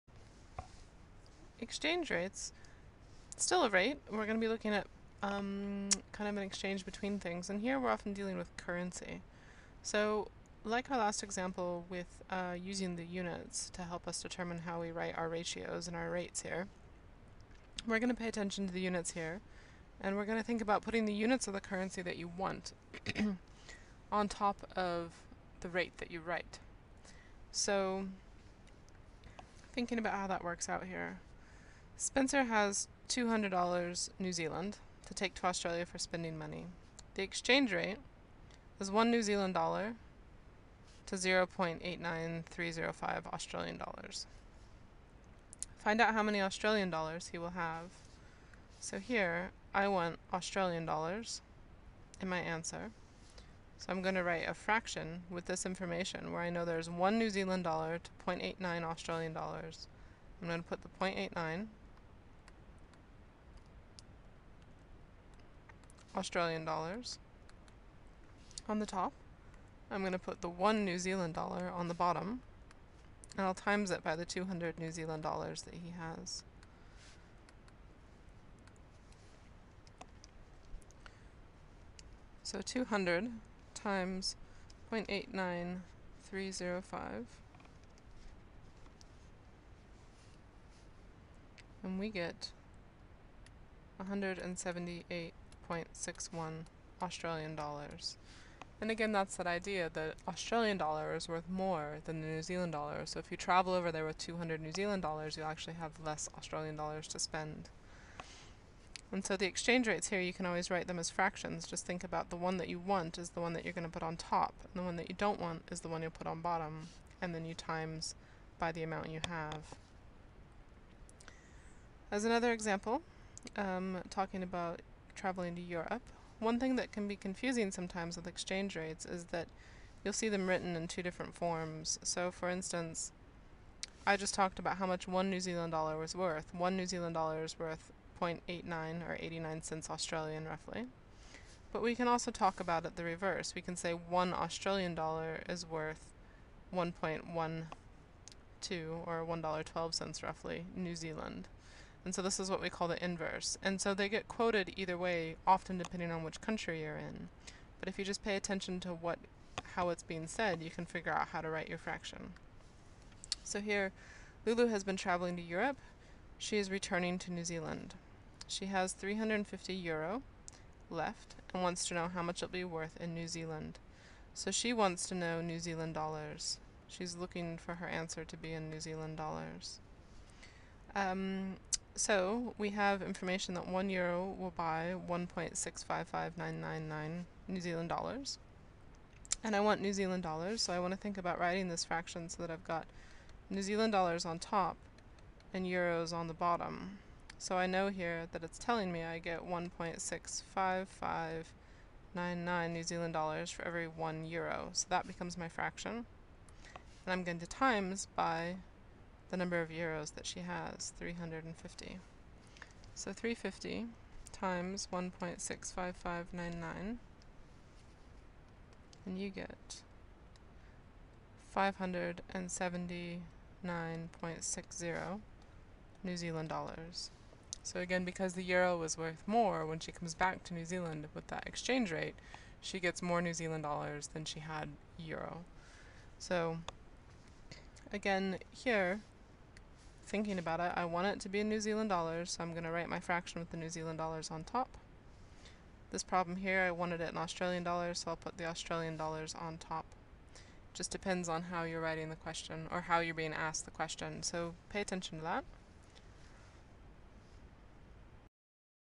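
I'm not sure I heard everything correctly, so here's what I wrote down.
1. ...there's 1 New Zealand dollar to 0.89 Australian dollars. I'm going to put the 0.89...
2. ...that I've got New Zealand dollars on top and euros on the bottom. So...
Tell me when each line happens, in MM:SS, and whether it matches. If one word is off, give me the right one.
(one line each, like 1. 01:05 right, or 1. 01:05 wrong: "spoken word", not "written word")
1. 00:56 right
2. 03:12 right.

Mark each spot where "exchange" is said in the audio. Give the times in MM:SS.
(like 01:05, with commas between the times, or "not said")
00:01, 00:06, 00:37, 01:49, 02:08, 03:51.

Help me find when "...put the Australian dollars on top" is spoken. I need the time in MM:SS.
04:08.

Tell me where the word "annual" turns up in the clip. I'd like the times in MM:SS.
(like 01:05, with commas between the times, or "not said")
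not said.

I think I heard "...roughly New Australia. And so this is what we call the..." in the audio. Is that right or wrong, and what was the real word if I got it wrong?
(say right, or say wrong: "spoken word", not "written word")
wrong: "Zealand", not "Australia".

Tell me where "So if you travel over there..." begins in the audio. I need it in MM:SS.
01:43.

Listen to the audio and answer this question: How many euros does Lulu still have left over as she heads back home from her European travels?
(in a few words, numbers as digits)
350 euro.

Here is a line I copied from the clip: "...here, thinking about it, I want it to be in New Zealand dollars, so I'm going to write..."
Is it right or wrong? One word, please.
right.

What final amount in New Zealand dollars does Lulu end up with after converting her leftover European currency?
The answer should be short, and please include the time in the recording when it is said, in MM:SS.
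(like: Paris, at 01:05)
579.60, at 03:41.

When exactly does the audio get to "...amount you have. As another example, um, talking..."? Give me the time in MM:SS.
01:58.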